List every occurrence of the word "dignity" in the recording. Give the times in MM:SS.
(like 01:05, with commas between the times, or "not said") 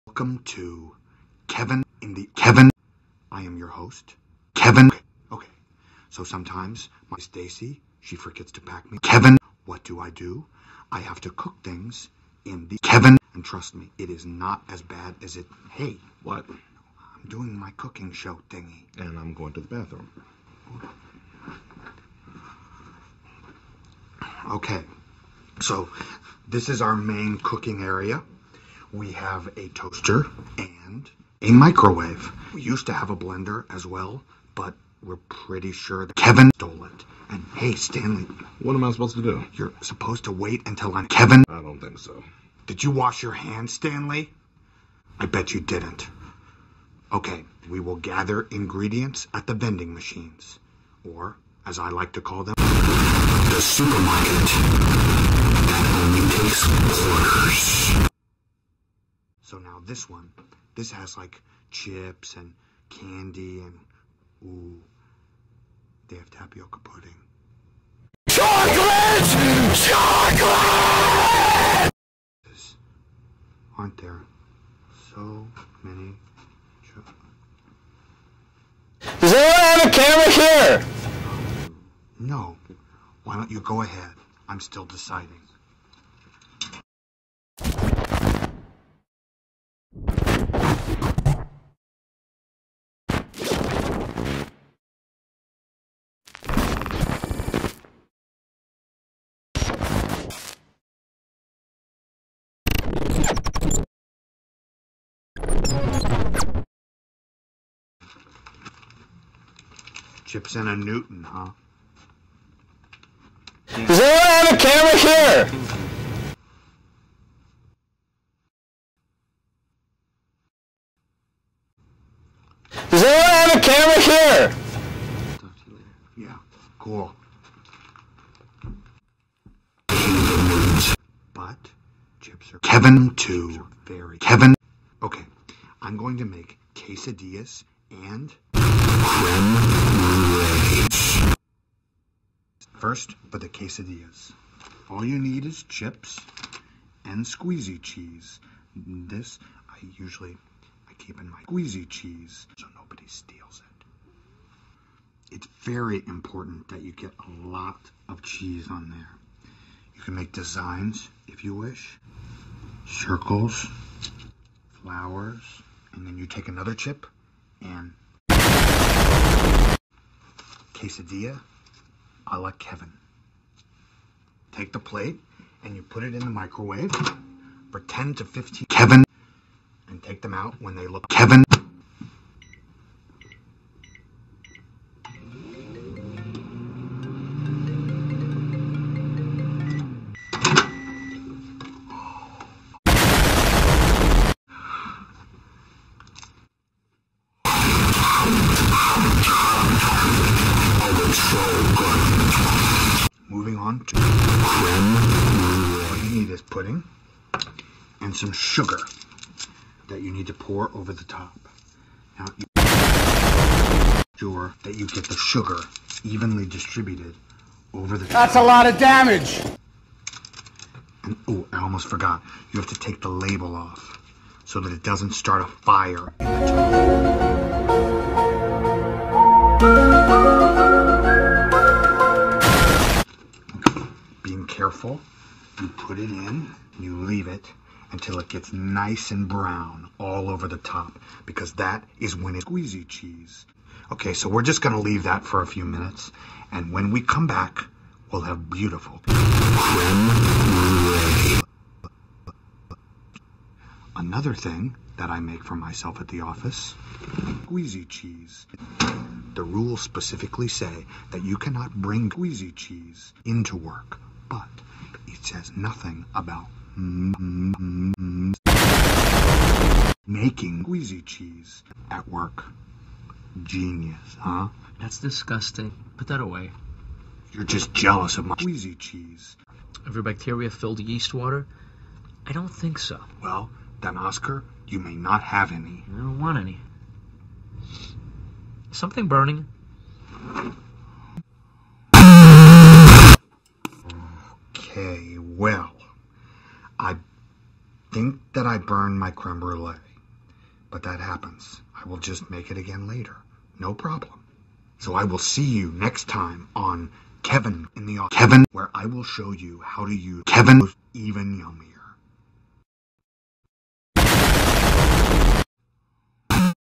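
not said.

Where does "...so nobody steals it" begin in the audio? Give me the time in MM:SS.
02:32.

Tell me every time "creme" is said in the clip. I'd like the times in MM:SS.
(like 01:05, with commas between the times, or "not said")
02:18, 04:59.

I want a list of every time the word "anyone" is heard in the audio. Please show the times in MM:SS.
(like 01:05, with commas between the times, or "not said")
01:19, 01:53, 02:03.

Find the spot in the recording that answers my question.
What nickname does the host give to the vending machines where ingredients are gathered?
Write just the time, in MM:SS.
00:52.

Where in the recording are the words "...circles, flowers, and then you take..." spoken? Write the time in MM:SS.
02:42.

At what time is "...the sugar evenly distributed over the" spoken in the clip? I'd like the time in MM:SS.
03:35.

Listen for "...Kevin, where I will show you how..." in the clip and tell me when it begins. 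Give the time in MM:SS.
05:08.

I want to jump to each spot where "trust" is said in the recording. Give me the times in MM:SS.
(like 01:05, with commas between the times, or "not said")
00:13.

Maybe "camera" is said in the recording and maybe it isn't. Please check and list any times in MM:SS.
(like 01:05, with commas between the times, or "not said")
01:19, 01:54, 02:03.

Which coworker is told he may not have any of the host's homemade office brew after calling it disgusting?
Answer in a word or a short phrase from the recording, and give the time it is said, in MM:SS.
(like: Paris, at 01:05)
Oscar, at 04:43.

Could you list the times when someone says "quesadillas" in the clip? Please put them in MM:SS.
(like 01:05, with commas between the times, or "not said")
02:16, 02:23, 02:50.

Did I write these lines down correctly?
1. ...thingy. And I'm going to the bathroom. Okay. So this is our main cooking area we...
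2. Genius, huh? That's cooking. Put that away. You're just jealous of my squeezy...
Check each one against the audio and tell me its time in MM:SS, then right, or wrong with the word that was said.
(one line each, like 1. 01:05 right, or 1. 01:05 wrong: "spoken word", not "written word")
1. 00:18 right
2. 04:33 wrong: "disgusting", not "cooking".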